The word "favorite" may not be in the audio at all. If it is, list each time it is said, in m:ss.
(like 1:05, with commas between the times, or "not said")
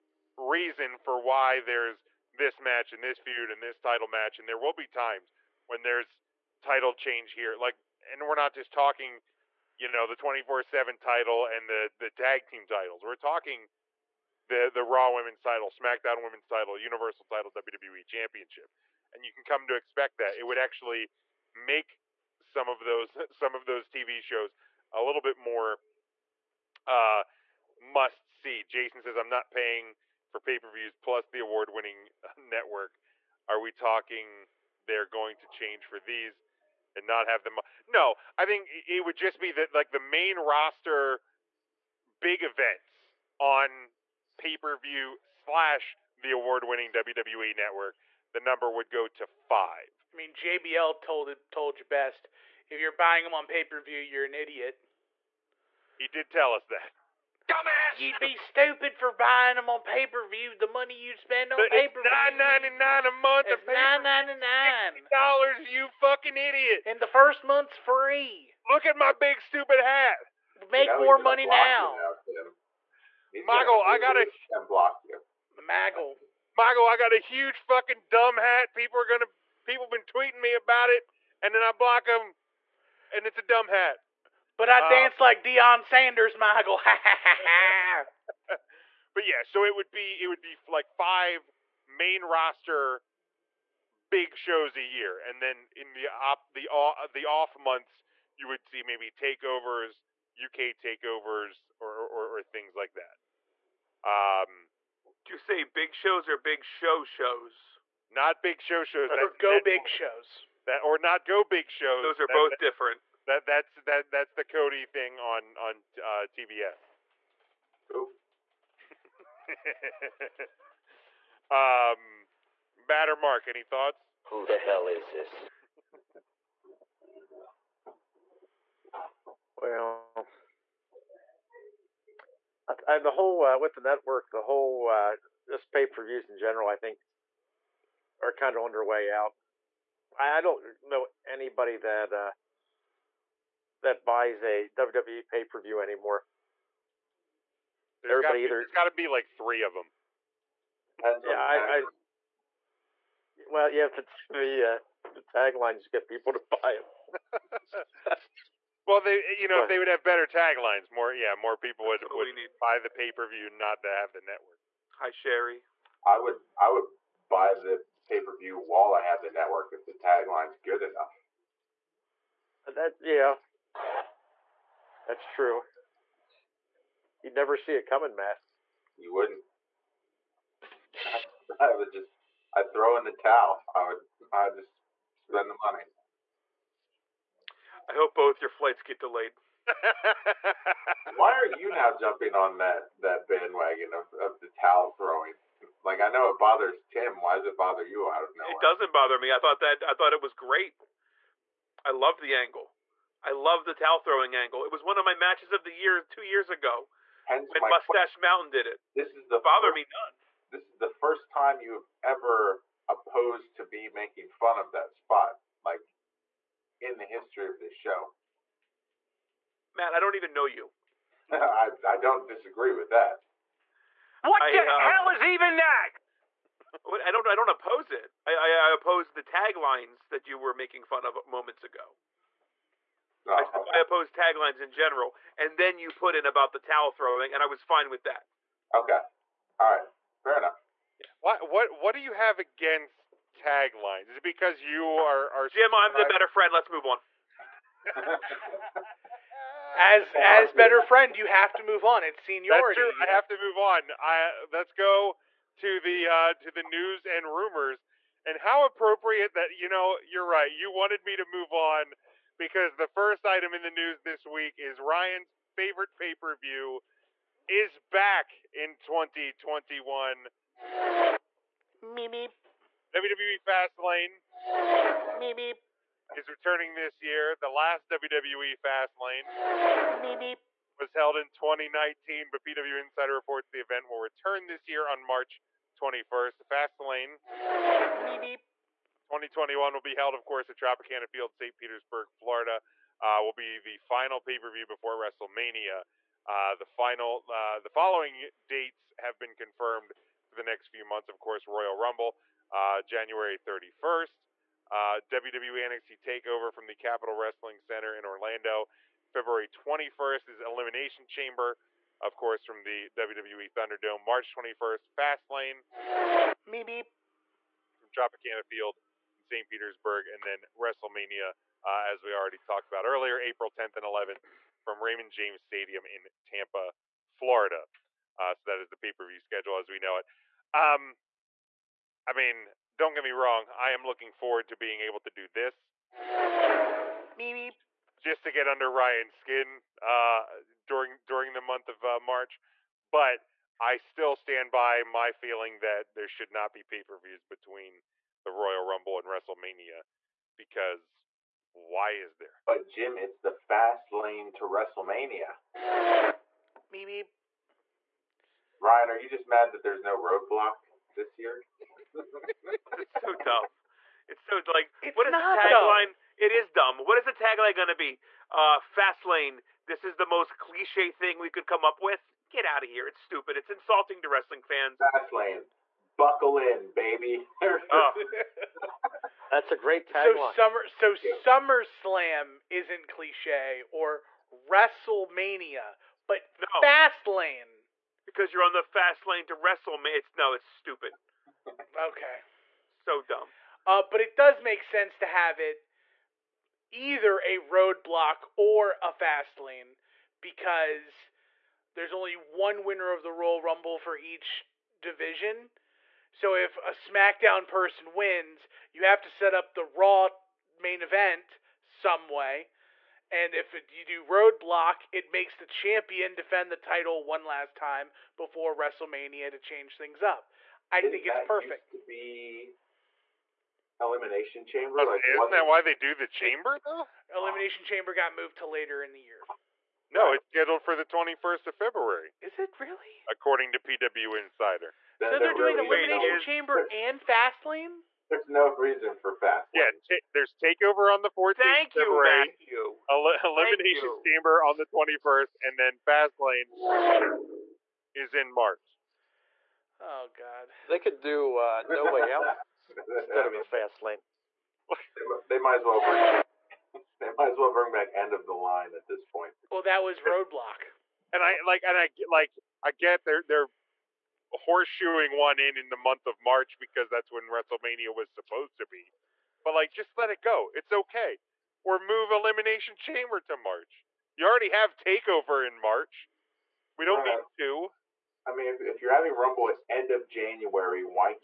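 4:25.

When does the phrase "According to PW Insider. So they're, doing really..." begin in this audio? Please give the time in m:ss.
7:13.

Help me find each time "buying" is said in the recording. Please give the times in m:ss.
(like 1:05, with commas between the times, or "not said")
0:52, 0:59.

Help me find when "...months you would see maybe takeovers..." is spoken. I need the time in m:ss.
1:37.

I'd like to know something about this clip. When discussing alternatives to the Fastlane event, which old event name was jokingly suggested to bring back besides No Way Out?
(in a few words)
End of the Line.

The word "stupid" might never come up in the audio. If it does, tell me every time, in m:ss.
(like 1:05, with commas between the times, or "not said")
0:58, 1:09, 6:13, 6:30.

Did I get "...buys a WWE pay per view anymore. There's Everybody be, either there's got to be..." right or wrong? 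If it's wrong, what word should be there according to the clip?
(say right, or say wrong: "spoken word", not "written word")
right.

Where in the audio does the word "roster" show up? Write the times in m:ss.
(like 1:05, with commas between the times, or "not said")
0:40, 1:32.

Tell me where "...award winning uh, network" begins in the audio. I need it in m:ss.
0:31.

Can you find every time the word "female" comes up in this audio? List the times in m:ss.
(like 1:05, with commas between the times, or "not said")
not said.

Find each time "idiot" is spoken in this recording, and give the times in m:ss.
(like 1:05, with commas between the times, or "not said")
0:54, 1:06.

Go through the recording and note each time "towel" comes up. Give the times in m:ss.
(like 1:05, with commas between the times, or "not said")
3:03, 3:14, 3:23, 3:56.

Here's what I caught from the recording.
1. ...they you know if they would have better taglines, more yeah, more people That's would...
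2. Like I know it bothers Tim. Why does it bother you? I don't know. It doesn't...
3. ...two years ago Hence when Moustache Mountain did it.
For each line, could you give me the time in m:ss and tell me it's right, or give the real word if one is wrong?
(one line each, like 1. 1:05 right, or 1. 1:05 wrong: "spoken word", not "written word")
1. 2:39 right
2. 3:15 right
3. 3:26 right.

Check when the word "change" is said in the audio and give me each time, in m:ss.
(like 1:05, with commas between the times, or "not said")
0:06, 0:35, 6:59.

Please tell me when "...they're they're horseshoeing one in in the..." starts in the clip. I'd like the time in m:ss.
7:43.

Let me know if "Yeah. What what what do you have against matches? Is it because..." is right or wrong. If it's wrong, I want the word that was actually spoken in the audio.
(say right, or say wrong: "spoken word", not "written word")
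wrong: "taglines", not "matches".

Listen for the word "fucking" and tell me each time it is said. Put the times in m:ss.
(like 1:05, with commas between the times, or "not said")
1:05, 1:17.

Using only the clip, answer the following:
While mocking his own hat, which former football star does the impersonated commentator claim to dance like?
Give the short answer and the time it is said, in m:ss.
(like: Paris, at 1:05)
Deion Sanders, at 1:25.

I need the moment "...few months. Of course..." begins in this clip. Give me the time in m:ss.
5:00.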